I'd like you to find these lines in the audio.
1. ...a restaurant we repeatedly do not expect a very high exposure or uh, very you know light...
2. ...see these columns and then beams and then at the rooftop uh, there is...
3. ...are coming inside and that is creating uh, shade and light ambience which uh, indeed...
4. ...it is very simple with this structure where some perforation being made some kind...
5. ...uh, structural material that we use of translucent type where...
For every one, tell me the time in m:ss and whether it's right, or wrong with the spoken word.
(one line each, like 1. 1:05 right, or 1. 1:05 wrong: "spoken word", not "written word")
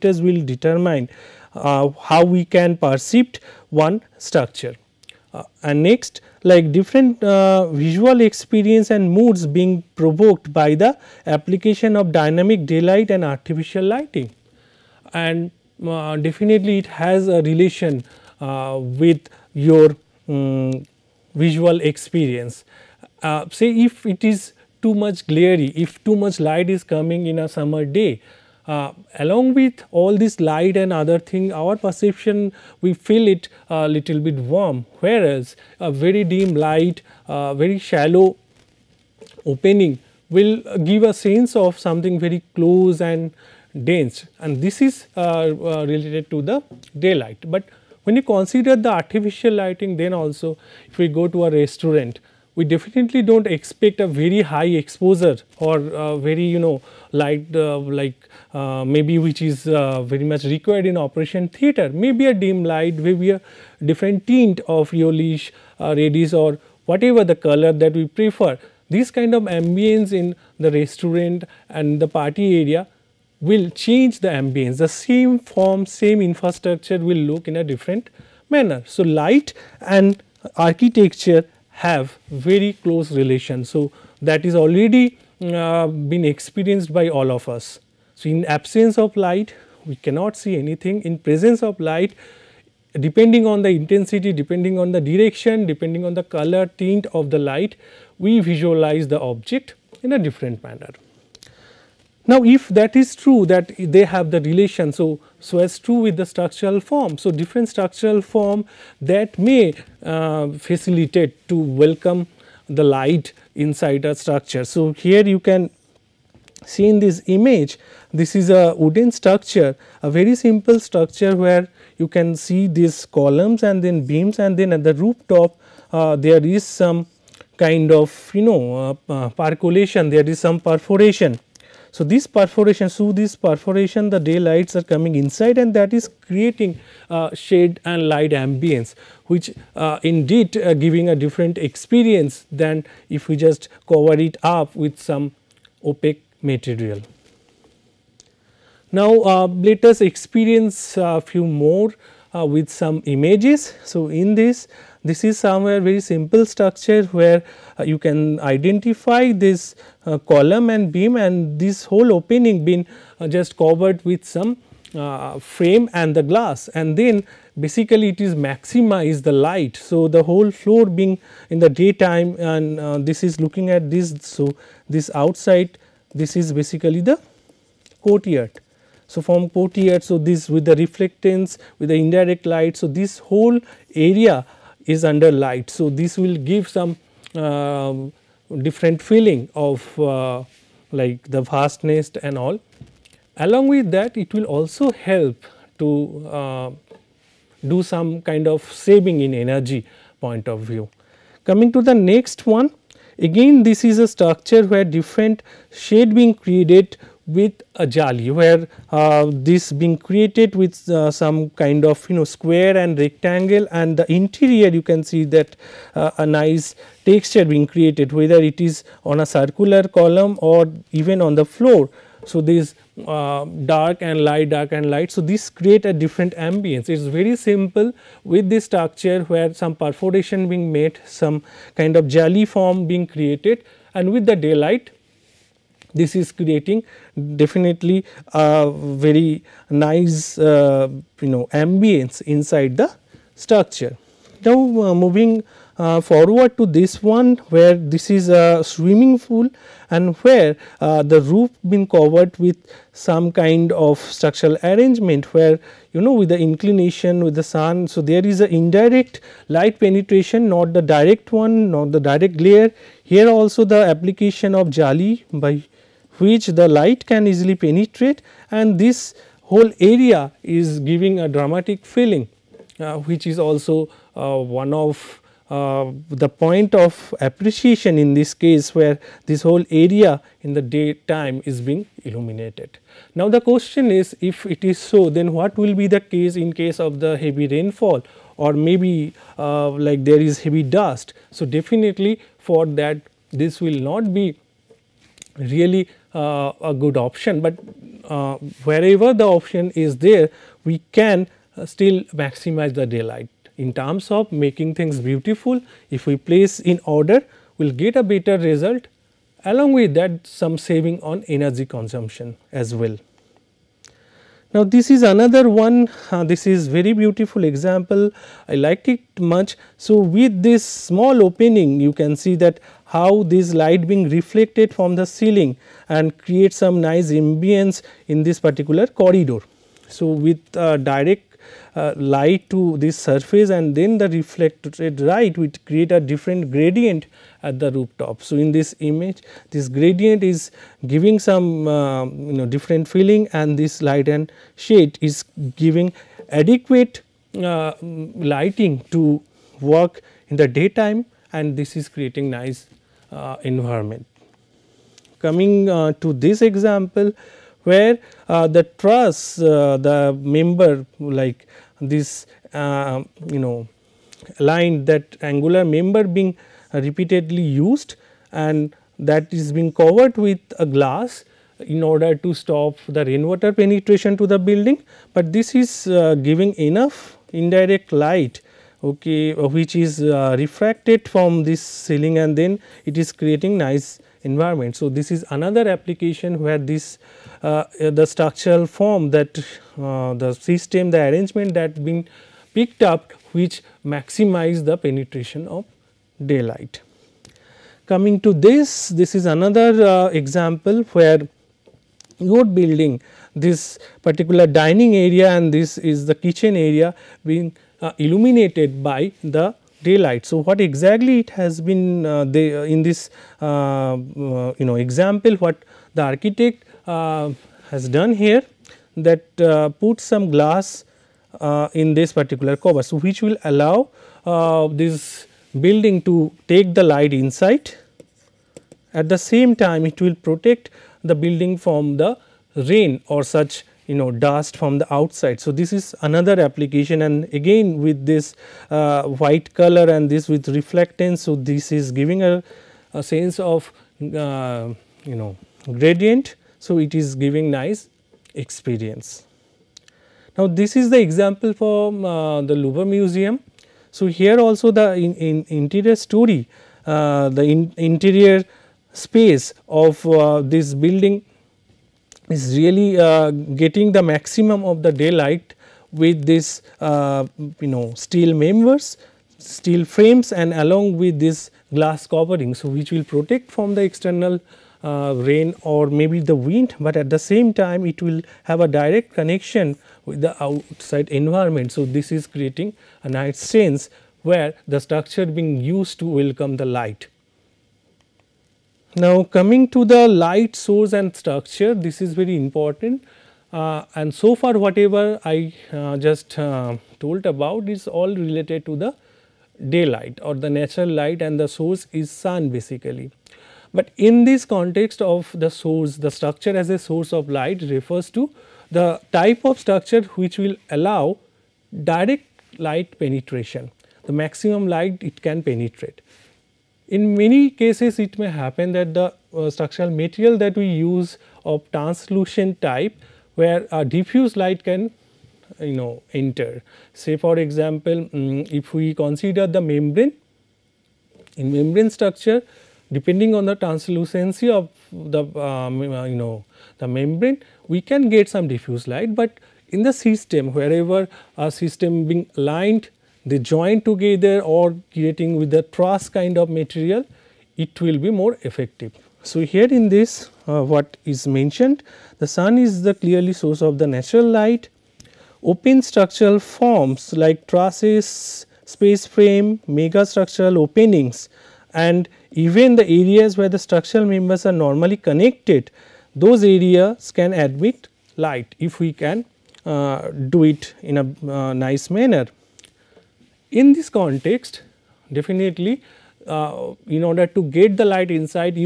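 1. 0:51 wrong: "definitely", not "repeatedly"
2. 2:02 right
3. 2:14 right
4. 3:46 right
5. 8:39 right.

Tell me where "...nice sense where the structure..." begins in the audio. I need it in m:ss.
8:03.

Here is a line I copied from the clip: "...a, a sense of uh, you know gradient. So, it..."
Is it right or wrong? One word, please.
right.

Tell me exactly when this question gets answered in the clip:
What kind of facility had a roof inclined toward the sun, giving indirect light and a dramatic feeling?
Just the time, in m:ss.
4:08.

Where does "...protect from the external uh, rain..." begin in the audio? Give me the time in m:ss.
7:53.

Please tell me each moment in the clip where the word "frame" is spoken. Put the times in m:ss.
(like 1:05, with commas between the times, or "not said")
2:45, 7:49, 9:19.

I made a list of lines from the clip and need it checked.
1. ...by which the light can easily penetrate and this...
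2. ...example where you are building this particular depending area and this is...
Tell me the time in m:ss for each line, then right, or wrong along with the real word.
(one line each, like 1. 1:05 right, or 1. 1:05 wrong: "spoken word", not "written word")
1. 4:25 right
2. 6:40 wrong: "dining", not "depending".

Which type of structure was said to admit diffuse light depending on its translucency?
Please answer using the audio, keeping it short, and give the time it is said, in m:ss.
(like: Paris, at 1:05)
Membrane structure, at 8:51.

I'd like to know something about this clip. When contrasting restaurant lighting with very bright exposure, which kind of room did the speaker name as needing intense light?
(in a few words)
Operation theater.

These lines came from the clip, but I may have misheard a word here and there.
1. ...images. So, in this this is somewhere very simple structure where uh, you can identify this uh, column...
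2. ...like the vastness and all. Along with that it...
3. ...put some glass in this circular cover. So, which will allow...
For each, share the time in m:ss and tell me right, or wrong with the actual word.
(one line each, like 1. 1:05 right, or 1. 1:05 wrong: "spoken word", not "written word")
1. 2:33 right
2. 3:10 right
3. 6:59 wrong: "particular", not "circular".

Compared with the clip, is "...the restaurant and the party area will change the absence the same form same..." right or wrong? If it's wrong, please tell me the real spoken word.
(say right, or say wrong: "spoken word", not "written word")
wrong: "ambience", not "absence".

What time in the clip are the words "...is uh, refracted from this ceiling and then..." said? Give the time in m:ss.
6:19.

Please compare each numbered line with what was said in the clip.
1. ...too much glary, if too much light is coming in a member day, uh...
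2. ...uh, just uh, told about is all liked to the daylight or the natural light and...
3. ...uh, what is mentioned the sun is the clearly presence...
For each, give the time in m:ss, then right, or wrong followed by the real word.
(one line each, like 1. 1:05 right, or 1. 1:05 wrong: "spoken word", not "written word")
1. 0:24 wrong: "summer", not "member"
2. 8:15 wrong: "related", not "liked"
3. 9:10 wrong: "source", not "presence".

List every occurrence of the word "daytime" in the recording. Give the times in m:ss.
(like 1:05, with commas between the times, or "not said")
2:51, 4:40, 5:50.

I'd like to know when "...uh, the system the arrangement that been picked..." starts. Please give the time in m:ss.
6:29.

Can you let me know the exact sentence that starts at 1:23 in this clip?
So, that is already uh, been experienced by all of us.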